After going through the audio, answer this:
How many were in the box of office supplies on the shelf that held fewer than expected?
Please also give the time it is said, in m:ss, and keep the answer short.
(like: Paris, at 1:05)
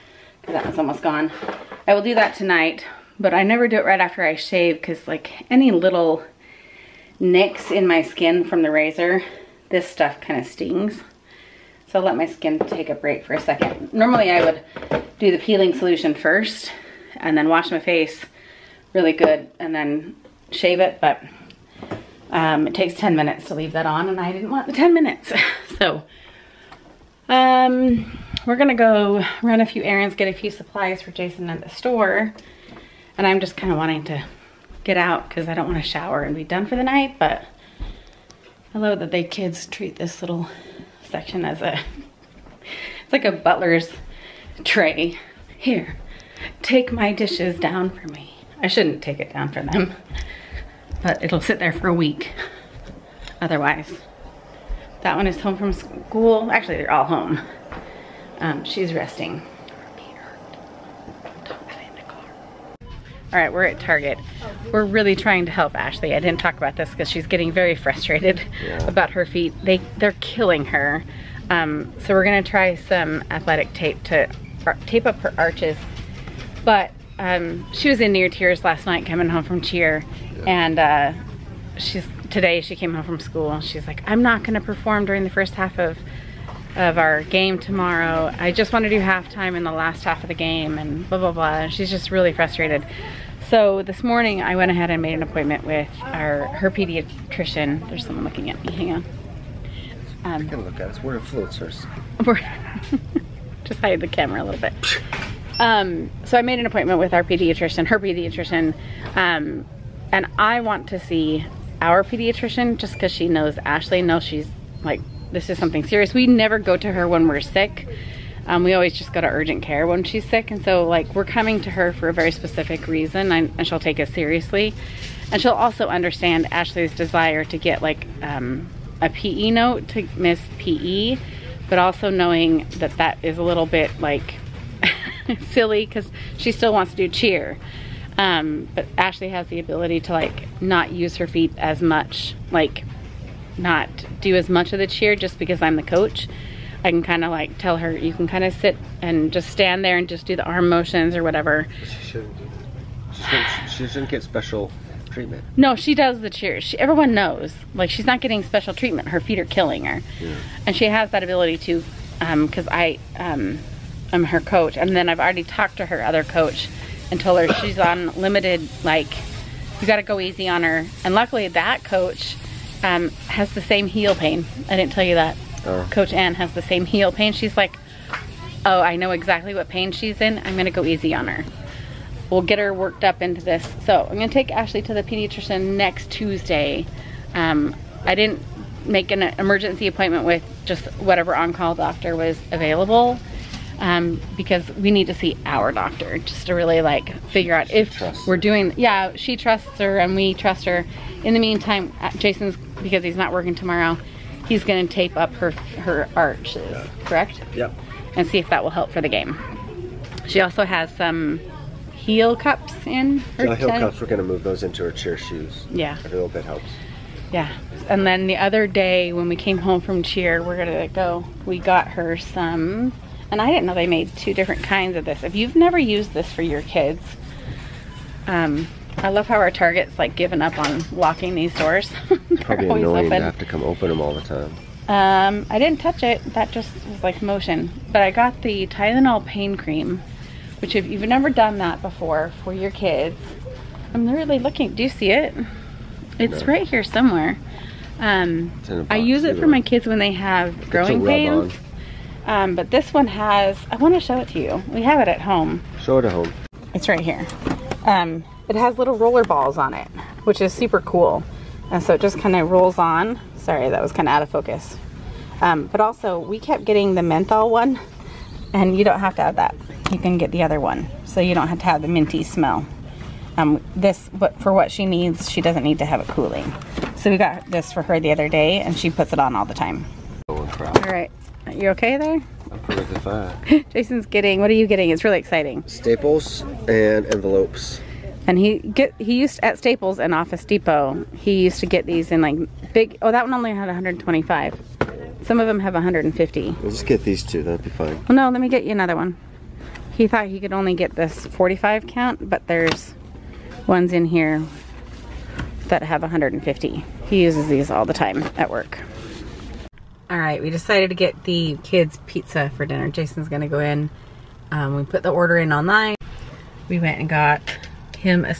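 125, at 4:53.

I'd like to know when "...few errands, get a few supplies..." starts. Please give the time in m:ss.
0:29.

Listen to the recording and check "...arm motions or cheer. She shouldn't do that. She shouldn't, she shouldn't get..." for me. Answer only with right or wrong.
wrong.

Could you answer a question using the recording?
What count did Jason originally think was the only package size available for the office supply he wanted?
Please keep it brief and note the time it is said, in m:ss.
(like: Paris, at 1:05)
45, at 5:01.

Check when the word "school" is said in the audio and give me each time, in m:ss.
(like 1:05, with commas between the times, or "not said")
0:55, 1:23.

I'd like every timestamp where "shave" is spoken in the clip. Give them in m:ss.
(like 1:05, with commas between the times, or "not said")
0:04, 0:20.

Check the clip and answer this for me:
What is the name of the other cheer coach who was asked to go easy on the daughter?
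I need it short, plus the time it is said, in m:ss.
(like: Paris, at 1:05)
Ann, at 2:55.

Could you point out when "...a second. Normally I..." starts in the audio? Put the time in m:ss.
0:13.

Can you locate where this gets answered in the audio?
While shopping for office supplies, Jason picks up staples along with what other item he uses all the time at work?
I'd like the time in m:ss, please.
4:47.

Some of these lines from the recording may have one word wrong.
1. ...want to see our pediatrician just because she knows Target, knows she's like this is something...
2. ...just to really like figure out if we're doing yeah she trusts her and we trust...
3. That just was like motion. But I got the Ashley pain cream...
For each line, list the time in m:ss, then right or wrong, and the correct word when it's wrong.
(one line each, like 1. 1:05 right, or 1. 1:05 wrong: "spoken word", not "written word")
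1. 1:50 wrong: "Ashley", not "Target"
2. 3:16 right
3. 3:56 wrong: "Tylenol", not "Ashley".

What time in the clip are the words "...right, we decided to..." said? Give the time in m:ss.
5:10.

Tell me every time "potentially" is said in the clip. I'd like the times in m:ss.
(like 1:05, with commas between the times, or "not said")
not said.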